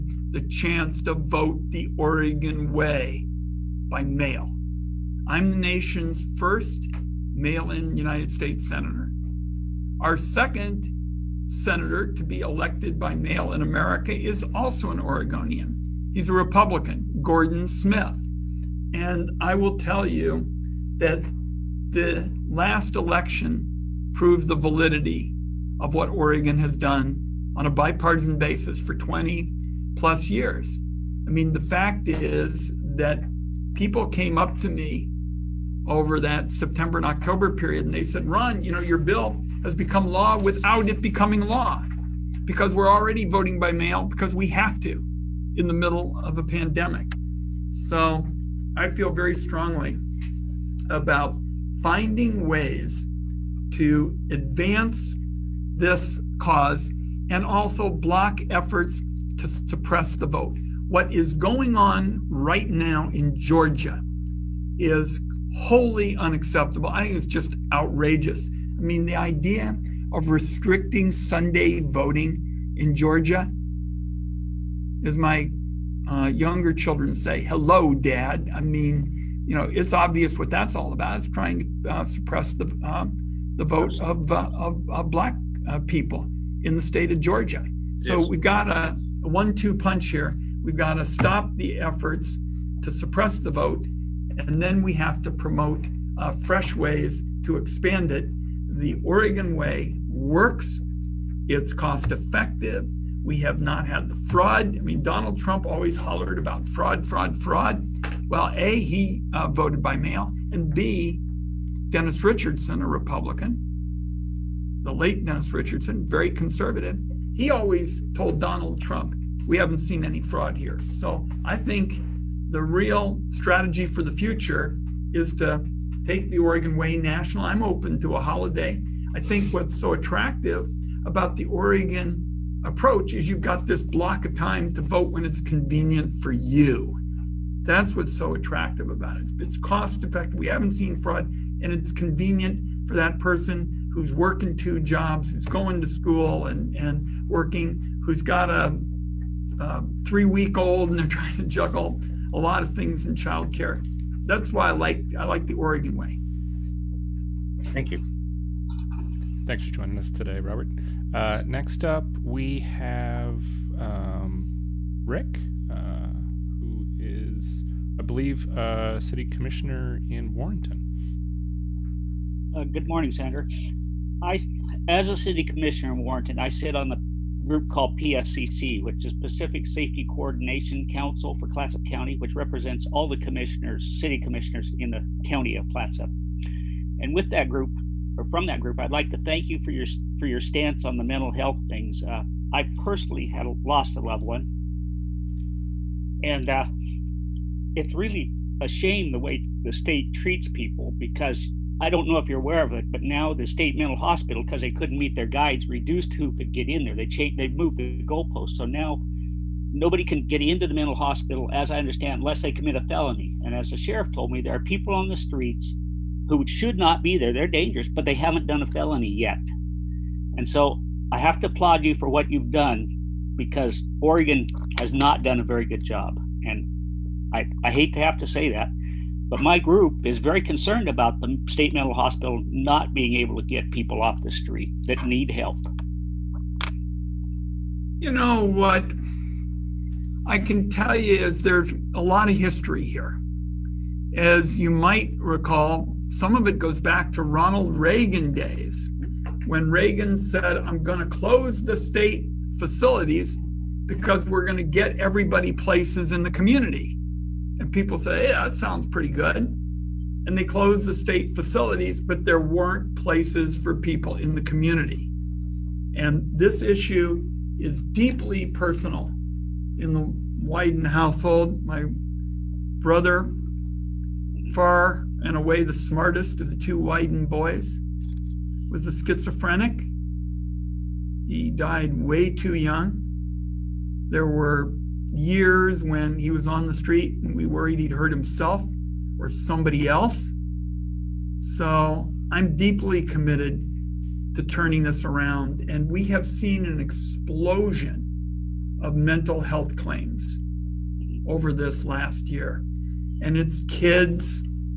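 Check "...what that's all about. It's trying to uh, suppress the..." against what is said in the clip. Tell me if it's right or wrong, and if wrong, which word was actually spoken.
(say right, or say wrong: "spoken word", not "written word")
right.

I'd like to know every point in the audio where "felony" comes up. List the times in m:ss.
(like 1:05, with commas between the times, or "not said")
3:32, 3:38.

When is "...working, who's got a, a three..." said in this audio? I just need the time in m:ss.
2:27.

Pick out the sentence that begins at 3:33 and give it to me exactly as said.
And as the sheriff told me, there are people on the streets who should not be there.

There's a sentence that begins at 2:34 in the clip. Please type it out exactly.
That's why I like I like the Oregon way.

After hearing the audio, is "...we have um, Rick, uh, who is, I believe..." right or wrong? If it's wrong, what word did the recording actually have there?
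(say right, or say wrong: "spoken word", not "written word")
right.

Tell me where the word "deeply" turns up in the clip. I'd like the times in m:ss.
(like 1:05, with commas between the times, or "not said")
4:27, 4:52.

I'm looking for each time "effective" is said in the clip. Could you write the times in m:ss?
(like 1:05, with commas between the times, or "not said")
1:42, 2:20.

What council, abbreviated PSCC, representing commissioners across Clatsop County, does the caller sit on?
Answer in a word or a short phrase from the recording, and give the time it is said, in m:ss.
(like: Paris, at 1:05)
Pacific Safety Coordination Council, at 2:59.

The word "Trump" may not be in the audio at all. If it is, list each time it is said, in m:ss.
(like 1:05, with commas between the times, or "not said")
1:45, 1:58.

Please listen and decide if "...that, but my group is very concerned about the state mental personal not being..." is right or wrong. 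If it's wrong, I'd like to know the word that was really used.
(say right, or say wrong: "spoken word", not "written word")
wrong: "hospital", not "personal".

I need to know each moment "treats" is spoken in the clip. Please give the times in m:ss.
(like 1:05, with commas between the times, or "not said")
3:20.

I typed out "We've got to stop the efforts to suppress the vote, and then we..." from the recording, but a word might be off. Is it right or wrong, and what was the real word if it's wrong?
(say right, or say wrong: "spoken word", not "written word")
right.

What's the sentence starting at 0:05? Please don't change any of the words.
I'm the nation's first mail in United States senator.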